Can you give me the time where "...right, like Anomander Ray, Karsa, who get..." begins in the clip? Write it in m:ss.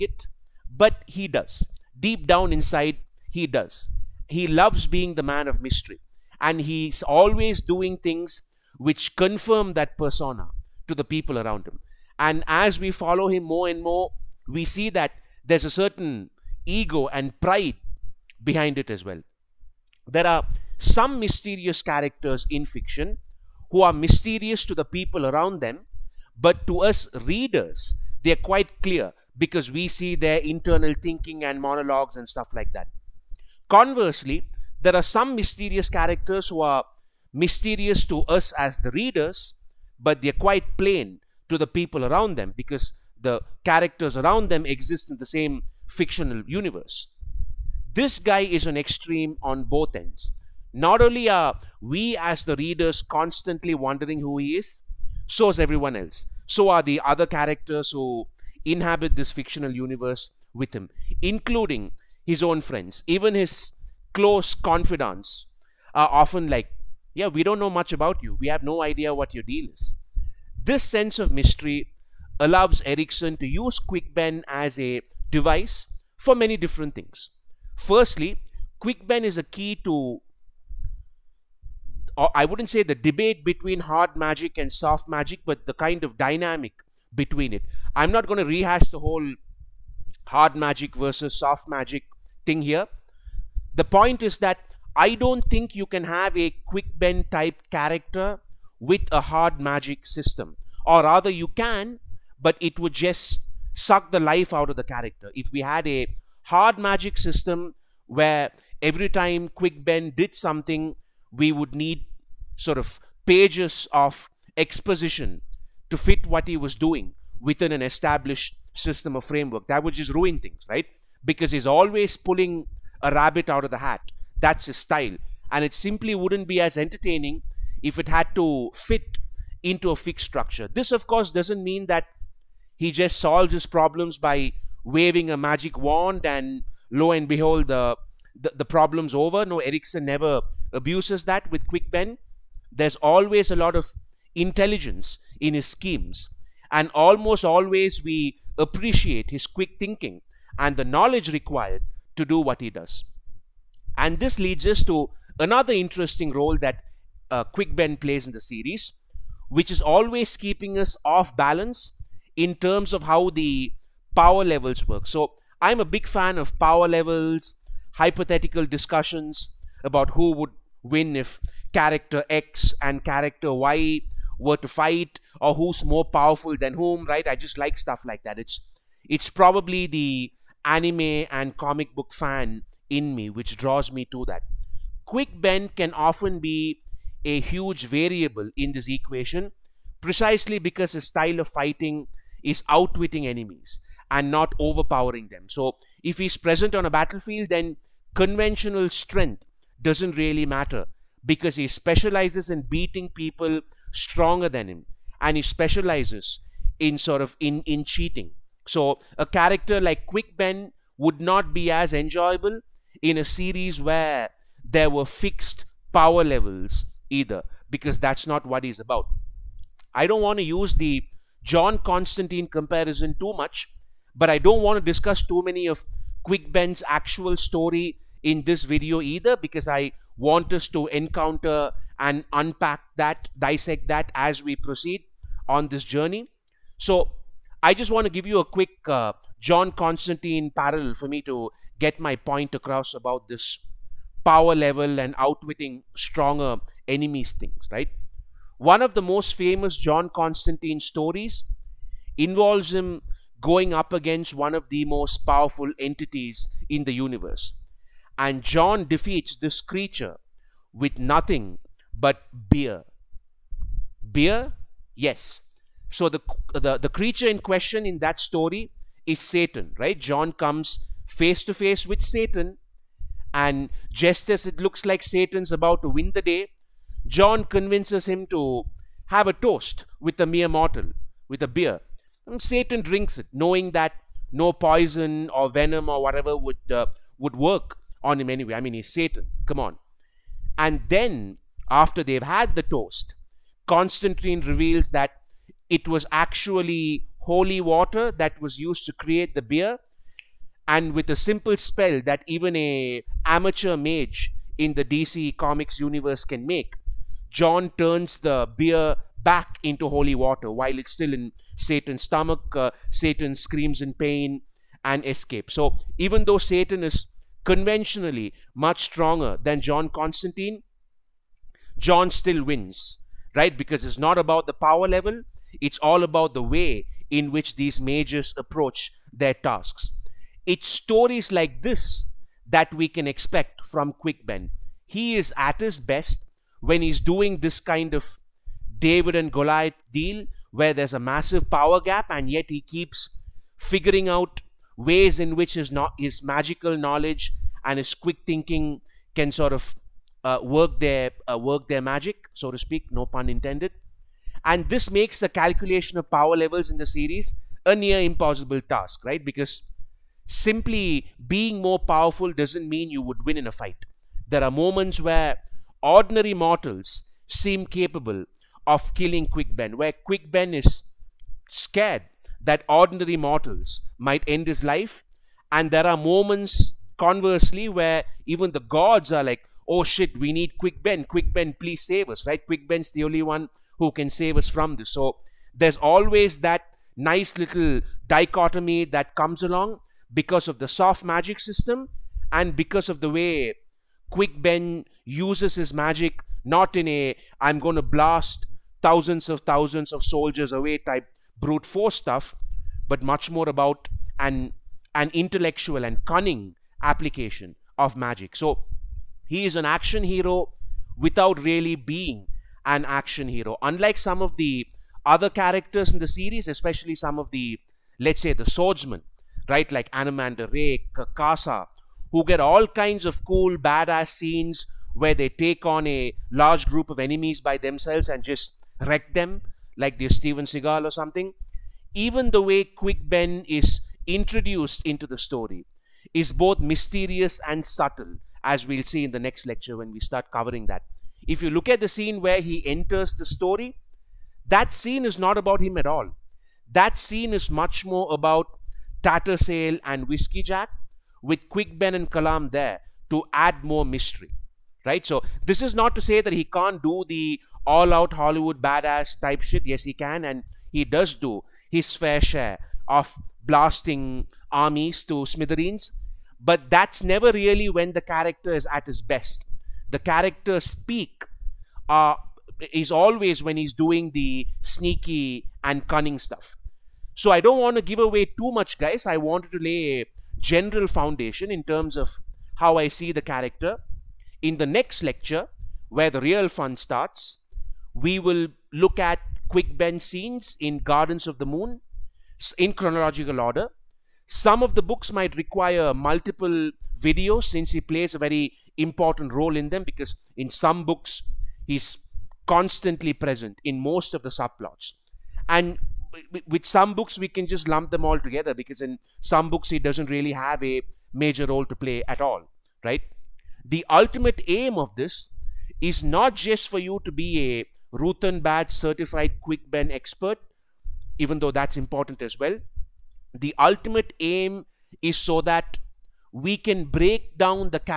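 6:59.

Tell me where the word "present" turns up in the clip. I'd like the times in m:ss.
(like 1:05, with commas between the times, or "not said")
3:16, 8:23.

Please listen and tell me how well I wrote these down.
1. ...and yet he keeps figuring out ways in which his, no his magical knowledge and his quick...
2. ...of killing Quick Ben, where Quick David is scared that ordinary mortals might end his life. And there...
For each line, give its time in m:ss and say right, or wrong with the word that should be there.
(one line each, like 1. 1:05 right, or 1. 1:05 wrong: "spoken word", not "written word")
1. 5:42 right
2. 6:08 wrong: "Ben", not "David".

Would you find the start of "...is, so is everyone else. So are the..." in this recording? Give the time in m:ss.
0:54.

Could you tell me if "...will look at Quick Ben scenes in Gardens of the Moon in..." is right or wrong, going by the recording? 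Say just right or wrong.
right.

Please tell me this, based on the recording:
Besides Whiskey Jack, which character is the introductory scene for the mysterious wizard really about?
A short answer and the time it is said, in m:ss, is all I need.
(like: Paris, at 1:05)
Tattersail, at 7:29.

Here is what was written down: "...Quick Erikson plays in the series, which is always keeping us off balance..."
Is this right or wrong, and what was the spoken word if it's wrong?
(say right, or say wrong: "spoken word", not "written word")
wrong: "Ben", not "Erikson".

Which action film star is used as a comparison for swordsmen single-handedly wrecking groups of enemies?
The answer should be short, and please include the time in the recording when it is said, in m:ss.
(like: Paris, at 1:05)
Steven Seagal, at 7:10.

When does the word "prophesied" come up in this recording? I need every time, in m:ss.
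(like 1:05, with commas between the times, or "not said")
not said.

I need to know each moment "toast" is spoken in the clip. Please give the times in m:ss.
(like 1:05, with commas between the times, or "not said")
4:39, 4:52.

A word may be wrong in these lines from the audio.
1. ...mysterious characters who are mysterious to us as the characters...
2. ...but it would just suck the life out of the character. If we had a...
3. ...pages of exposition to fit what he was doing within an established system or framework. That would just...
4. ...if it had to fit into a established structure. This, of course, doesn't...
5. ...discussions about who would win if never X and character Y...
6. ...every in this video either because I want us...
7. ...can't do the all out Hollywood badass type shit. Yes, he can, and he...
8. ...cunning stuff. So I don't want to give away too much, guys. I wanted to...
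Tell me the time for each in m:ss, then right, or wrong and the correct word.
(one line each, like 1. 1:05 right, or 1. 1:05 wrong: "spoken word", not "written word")
1. 0:35 wrong: "readers", not "characters"
2. 1:42 right
3. 1:53 right
4. 2:07 wrong: "fixed", not "established"
5. 2:48 wrong: "character", not "never"
6. 3:47 wrong: "story", not "every"
7. 7:36 right
8. 7:55 right.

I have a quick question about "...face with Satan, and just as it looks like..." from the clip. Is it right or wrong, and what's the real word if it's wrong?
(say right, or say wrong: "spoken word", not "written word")
right.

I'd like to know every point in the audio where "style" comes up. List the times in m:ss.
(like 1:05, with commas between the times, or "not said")
2:04, 3:11.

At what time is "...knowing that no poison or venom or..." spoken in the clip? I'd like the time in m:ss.
4:43.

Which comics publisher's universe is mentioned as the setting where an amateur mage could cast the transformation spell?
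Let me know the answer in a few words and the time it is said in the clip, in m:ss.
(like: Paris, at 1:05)
DC Comics, at 5:04.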